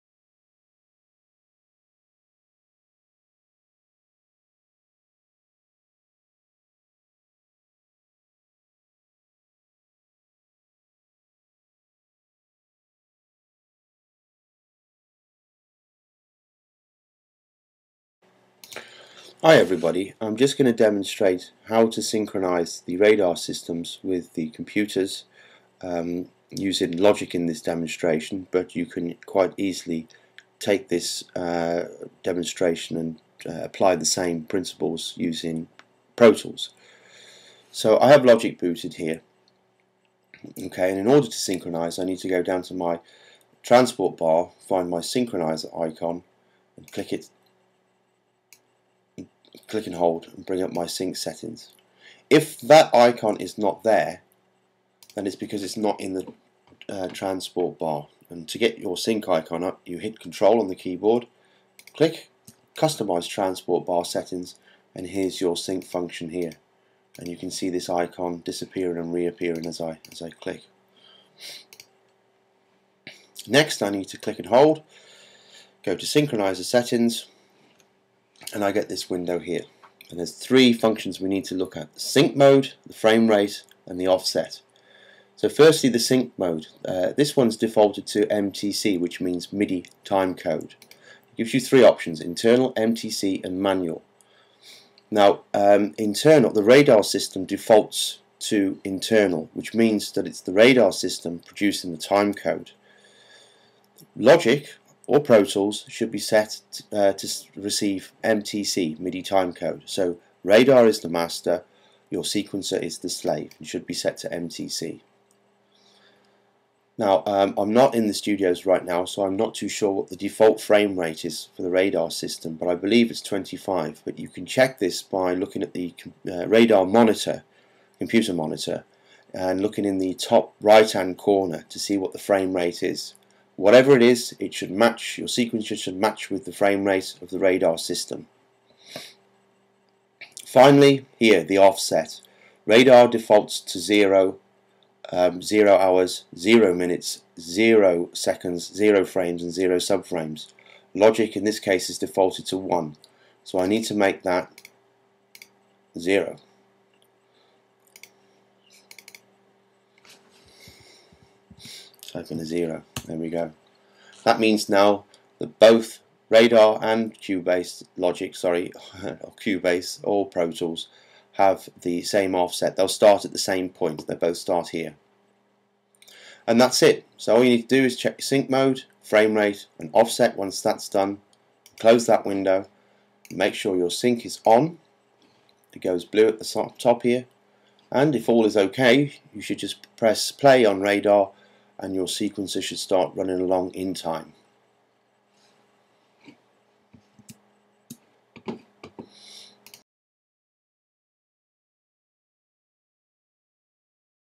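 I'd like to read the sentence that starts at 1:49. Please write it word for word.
So radar is the master, your sequencer is the slave and should be set to MTC.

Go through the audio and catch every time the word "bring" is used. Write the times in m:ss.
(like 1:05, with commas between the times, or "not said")
0:50.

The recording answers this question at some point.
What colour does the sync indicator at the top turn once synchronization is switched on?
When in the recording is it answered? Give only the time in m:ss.
3:06.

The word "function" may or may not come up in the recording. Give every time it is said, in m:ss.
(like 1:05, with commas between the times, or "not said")
1:05, 1:20.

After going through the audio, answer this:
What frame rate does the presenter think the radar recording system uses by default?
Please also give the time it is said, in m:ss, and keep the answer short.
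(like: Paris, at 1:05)
25, at 2:03.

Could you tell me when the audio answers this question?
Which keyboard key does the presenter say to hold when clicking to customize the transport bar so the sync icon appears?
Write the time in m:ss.
1:00.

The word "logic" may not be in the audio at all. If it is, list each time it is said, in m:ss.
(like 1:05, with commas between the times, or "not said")
0:26, 0:38, 1:44, 2:30, 2:47.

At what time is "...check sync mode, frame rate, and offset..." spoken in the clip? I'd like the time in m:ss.
2:57.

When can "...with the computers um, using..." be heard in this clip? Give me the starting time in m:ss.
0:24.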